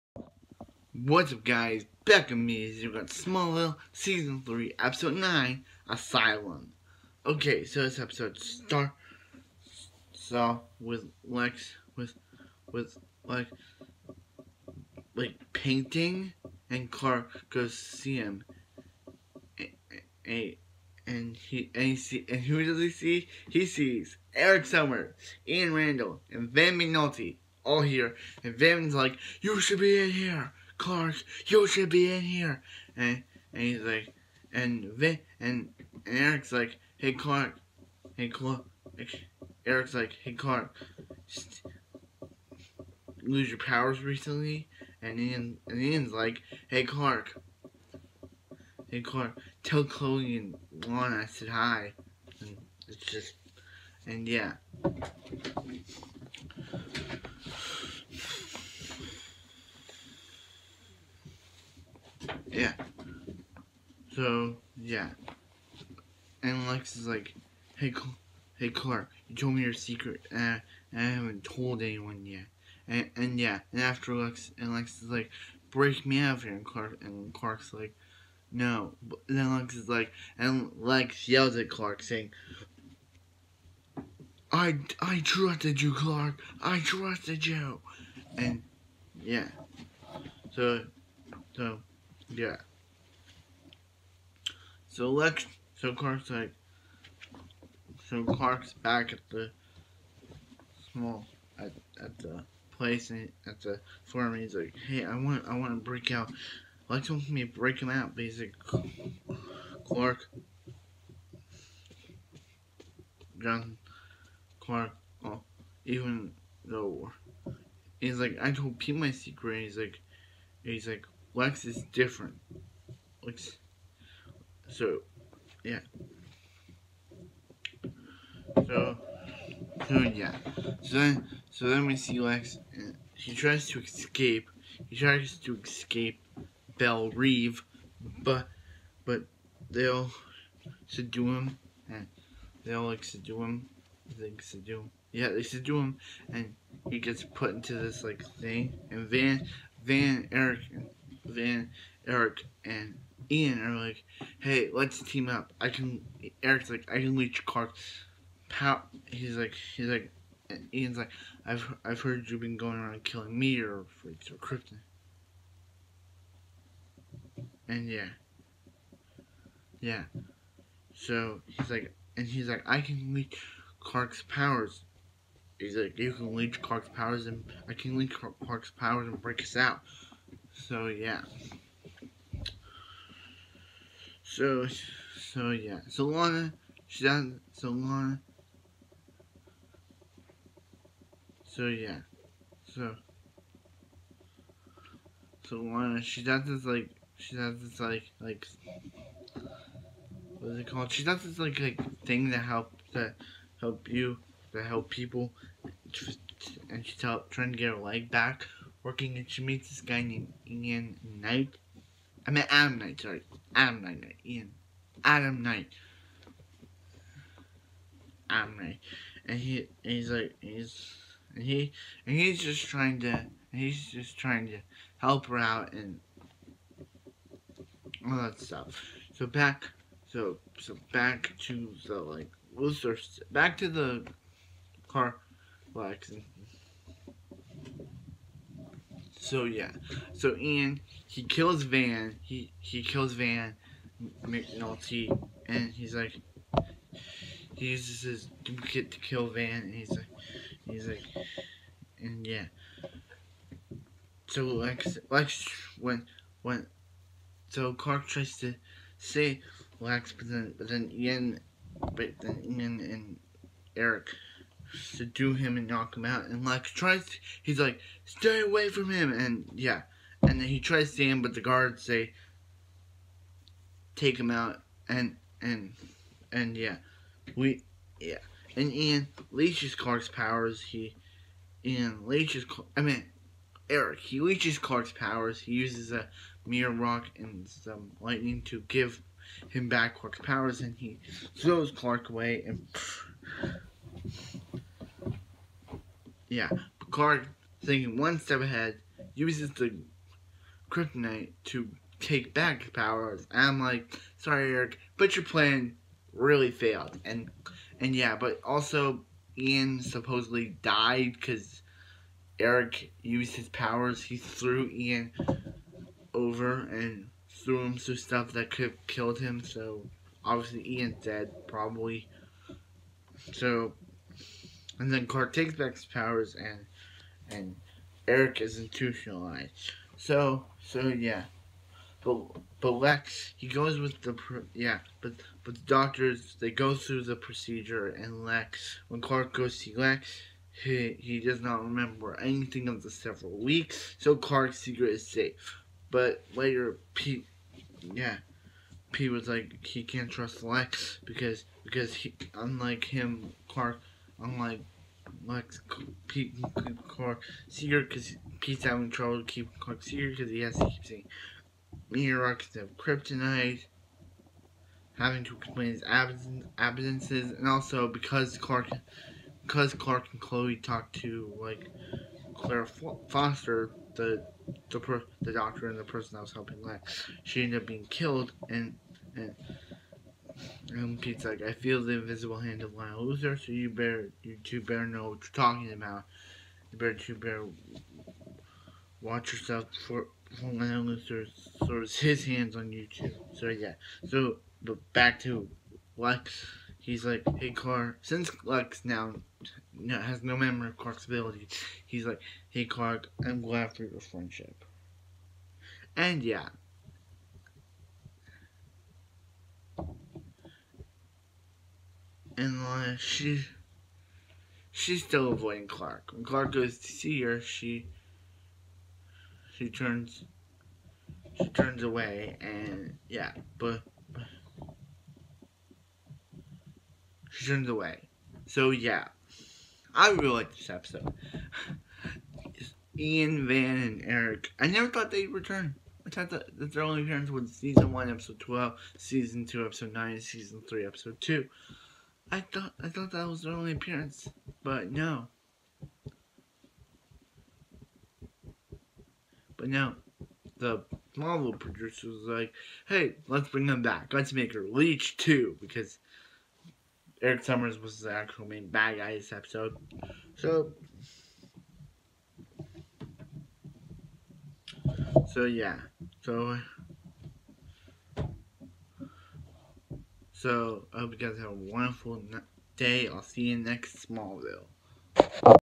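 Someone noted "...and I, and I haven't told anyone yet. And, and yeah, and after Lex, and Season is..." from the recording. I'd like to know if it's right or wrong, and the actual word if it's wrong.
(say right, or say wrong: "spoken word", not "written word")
wrong: "Lex", not "Season".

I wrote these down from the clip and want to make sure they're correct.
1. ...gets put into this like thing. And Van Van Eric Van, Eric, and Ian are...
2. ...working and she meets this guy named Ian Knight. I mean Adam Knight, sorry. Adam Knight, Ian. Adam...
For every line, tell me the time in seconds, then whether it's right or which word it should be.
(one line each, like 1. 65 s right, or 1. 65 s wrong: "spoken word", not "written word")
1. 146 s right
2. 208 s right.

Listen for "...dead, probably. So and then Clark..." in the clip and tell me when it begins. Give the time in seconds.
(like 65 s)
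321 s.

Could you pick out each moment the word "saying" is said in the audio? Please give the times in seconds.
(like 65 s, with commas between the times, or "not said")
82 s, 360 s.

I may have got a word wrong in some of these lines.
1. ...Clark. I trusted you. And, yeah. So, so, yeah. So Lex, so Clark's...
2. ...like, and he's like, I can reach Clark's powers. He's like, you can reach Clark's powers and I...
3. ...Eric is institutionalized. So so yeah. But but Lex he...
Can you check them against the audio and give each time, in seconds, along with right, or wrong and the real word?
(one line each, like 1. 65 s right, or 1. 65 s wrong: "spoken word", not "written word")
1. 85 s right
2. 171 s right
3. 328 s right.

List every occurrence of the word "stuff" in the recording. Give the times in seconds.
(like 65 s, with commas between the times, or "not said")
228 s, 317 s.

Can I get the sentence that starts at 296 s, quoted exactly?
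Yeah, Picard, thinking one step ahead, uses the kryptonite to take back his powers.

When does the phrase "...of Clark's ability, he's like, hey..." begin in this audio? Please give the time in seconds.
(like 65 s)
400 s.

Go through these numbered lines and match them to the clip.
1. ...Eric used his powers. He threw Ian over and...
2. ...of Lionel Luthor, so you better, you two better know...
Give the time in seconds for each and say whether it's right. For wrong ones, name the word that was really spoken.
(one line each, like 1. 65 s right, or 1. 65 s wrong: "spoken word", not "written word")
1. 312 s right
2. 382 s right.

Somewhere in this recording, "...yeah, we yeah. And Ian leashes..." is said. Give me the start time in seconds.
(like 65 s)
276 s.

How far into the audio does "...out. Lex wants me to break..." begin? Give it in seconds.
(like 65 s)
106 s.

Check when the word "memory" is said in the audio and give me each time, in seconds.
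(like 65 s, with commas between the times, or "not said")
400 s.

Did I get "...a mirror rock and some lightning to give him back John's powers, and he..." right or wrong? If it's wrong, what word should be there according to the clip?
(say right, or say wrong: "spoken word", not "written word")
wrong: "Clark", not "John".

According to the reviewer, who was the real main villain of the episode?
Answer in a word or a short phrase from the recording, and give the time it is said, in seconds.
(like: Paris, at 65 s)
Eric Summers, at 457 s.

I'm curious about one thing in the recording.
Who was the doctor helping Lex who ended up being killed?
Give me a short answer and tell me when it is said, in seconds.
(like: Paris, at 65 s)
Claire Foster, at 372 s.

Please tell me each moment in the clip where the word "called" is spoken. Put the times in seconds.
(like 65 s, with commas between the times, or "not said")
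200 s.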